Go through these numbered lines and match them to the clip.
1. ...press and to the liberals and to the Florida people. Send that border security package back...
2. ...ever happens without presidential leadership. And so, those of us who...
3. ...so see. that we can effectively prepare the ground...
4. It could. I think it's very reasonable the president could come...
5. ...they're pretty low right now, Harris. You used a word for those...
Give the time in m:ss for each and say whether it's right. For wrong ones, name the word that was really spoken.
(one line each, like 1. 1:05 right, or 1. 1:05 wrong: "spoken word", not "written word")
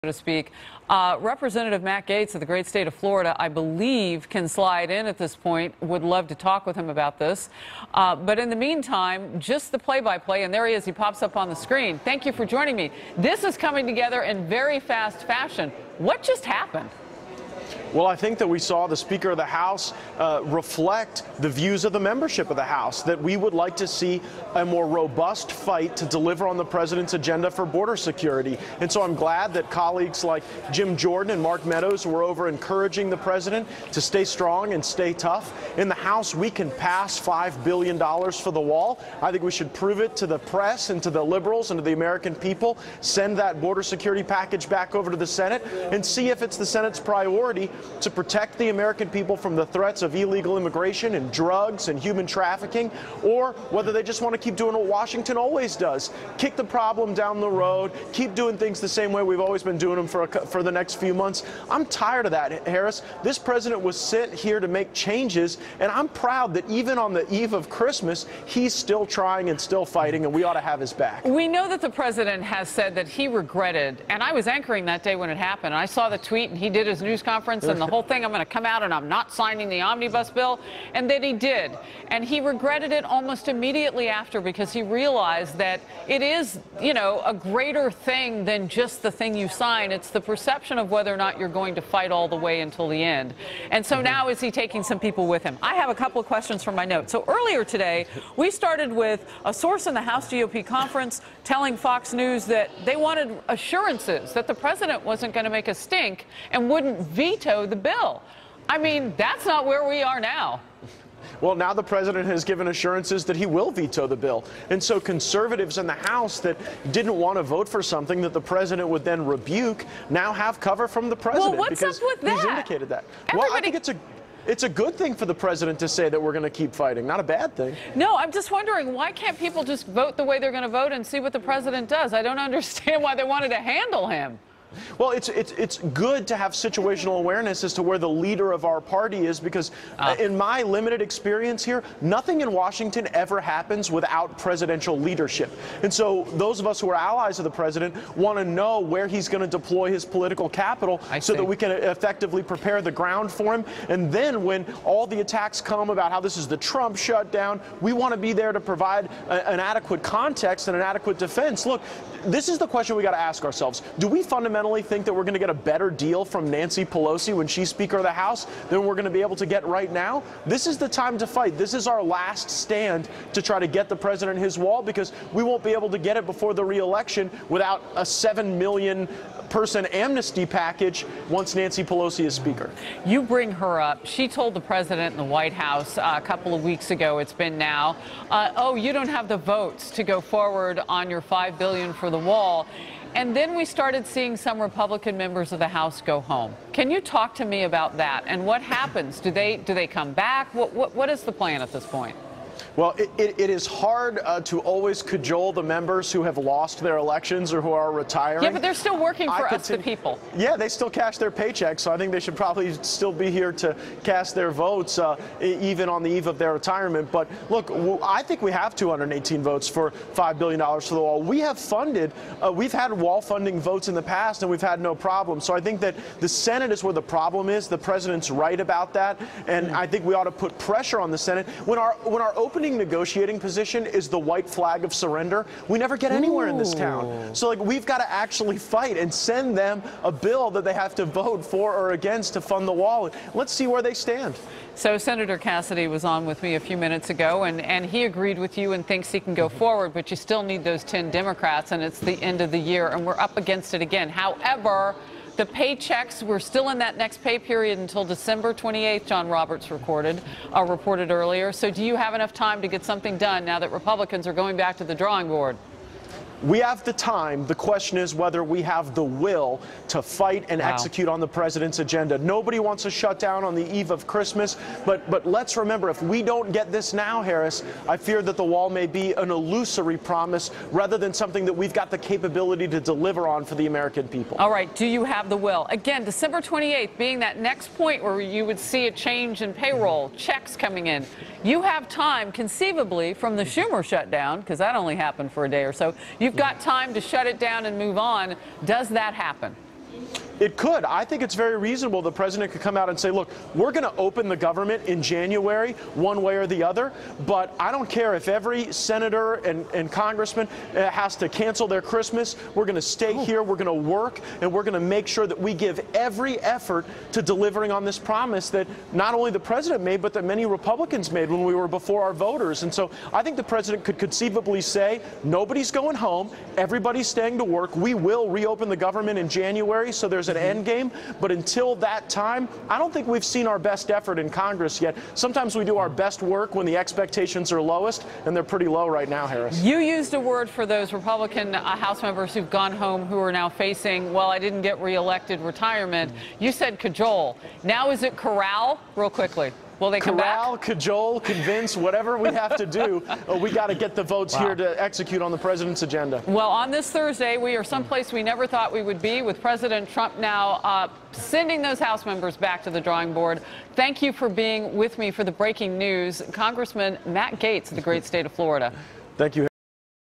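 1. 0:40 wrong: "American", not "Florida"
2. 2:23 right
3. 2:31 right
4. 5:00 right
5. 5:38 right.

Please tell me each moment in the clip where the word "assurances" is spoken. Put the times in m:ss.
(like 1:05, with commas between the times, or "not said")
1:43, 1:52.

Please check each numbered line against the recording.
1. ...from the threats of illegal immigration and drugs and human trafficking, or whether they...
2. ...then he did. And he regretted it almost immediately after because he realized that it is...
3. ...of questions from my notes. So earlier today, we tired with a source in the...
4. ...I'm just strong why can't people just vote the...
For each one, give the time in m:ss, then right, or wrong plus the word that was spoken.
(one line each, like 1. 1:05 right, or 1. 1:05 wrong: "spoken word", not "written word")
1. 0:49 right
2. 1:21 right
3. 1:36 wrong: "started", not "tired"
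4. 2:08 wrong: "wondering", not "strong".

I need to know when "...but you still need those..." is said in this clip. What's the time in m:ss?
4:09.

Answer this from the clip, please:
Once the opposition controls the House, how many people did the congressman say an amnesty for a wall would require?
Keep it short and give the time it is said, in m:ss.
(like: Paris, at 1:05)
7 million person, at 2:58.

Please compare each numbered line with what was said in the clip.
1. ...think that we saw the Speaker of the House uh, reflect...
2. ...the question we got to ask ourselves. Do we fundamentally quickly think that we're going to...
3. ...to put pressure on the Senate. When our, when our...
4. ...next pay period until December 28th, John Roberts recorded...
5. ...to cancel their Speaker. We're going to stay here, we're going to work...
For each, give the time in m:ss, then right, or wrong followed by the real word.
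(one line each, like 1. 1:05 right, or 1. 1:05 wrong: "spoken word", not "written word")
1. 0:18 right
2. 2:42 wrong: "fundamentally", not "quickly"
3. 3:50 right
4. 4:16 right
5. 5:11 wrong: "Christmas", not "Speaker".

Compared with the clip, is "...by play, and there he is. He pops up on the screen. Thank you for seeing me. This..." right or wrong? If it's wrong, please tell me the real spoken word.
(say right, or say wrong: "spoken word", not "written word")
wrong: "joining", not "seeing".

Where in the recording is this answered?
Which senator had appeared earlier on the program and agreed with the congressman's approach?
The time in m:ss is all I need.
4:05.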